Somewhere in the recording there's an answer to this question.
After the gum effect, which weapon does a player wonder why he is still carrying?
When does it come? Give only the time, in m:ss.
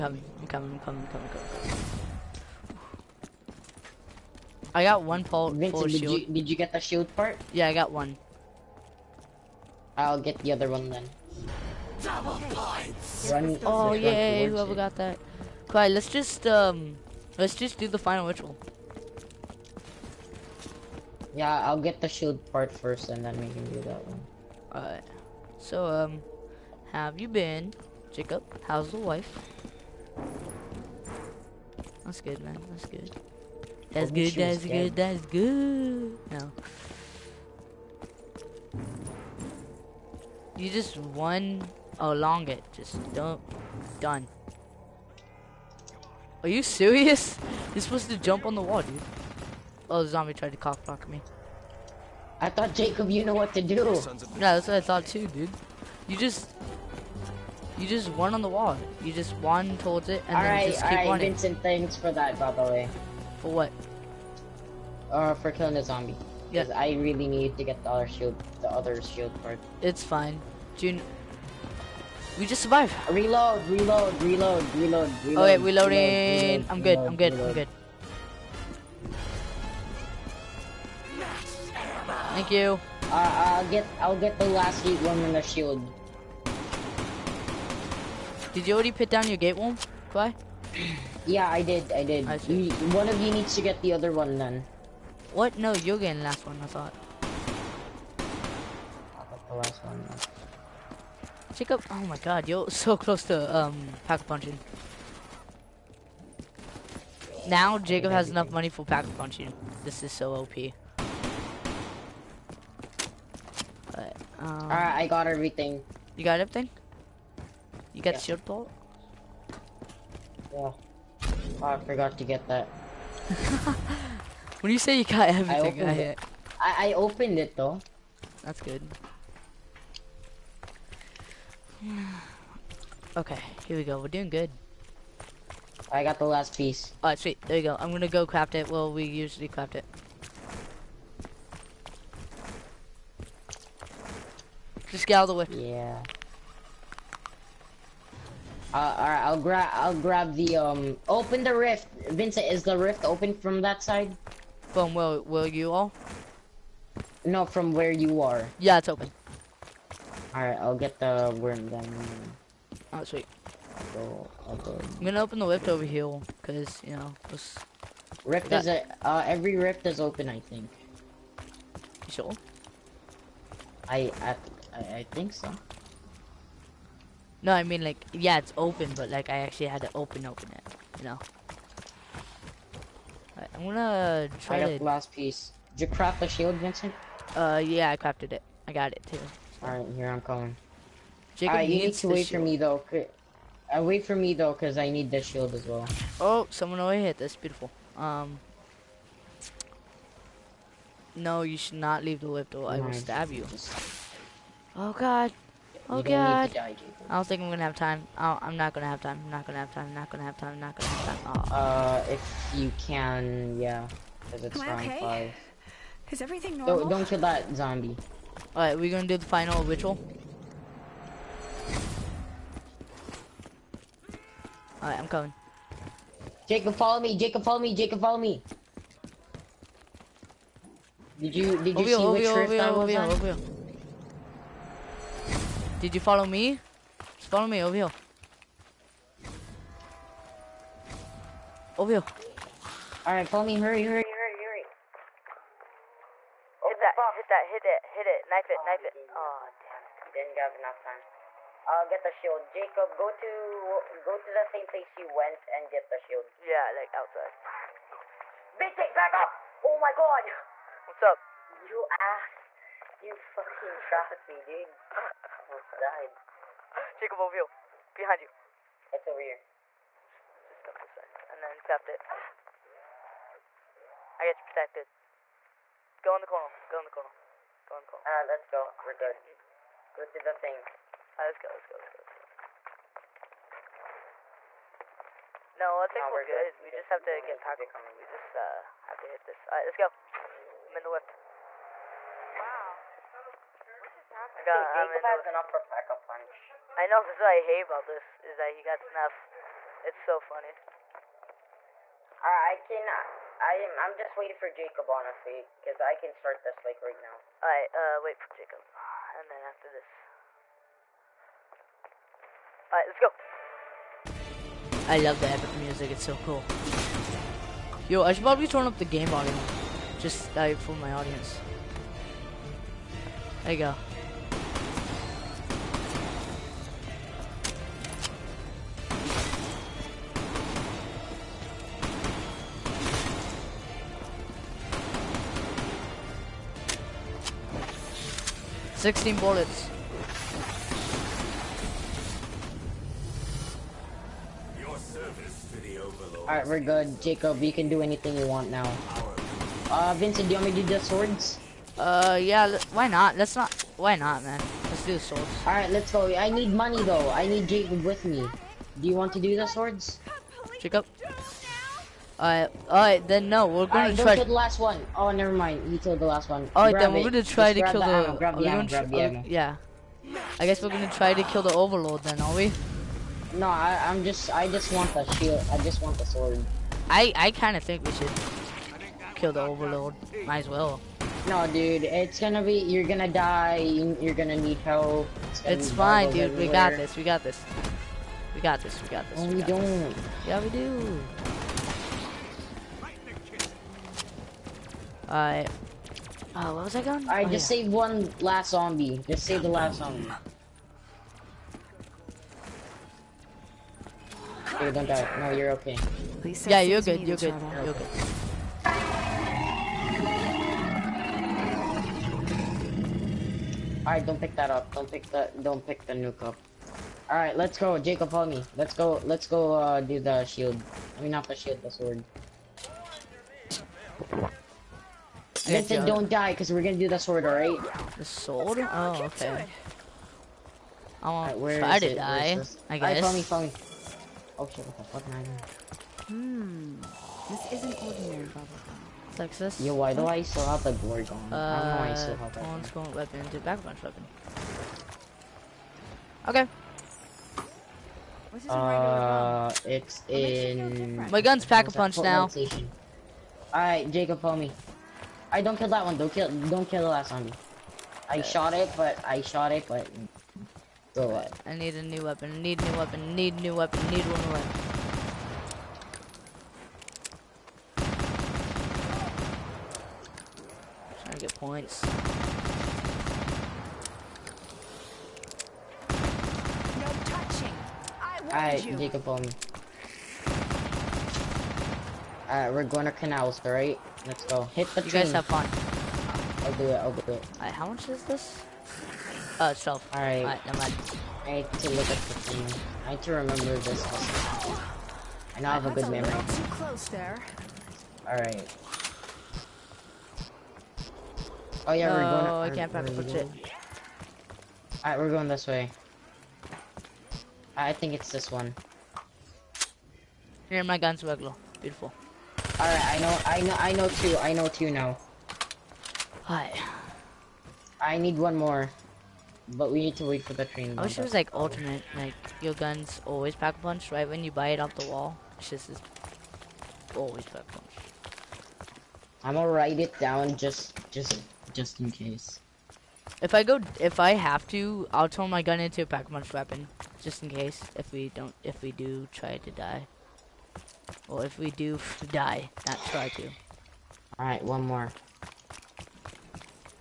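7:20.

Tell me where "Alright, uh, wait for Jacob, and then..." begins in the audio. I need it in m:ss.
5:07.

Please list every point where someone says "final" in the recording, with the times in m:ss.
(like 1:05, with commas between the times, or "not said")
0:17, 3:39.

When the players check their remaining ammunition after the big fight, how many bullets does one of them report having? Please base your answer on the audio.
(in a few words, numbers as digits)
16.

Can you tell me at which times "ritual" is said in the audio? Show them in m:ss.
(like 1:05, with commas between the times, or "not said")
0:18, 3:39.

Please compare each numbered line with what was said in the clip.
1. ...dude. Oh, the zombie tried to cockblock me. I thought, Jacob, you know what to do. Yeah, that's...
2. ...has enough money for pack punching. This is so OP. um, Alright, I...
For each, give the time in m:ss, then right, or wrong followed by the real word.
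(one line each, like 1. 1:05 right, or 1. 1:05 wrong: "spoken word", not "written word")
1. 0:48 right
2. 1:48 right.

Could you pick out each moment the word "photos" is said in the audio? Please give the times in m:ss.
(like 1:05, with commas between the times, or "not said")
not said.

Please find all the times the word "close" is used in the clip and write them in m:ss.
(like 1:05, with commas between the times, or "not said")
1:42, 8:16.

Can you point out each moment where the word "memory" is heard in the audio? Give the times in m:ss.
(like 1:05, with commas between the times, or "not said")
8:15.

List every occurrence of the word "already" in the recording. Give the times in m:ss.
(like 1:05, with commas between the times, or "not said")
1:28, 3:16.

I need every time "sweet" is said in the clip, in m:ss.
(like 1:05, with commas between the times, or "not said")
2:17, 2:43.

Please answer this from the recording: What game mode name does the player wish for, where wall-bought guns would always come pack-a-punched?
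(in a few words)
ultimate.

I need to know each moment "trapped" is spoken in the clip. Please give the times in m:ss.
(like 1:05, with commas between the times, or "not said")
4:23, 4:31.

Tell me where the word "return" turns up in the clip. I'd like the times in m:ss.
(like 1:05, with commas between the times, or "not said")
not said.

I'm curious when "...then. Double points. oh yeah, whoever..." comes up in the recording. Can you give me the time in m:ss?
0:10.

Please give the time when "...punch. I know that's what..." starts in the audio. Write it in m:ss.
4:55.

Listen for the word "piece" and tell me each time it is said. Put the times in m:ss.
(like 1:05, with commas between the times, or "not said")
2:16, 3:05.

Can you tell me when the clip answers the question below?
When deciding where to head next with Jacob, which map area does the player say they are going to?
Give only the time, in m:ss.
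8:02.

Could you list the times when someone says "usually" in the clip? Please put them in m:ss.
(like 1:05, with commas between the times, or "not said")
2:19.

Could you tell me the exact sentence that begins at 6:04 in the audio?
Oh, never mind, you killed the last one.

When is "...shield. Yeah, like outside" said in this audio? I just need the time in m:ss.
4:15.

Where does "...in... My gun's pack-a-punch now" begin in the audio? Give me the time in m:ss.
7:30.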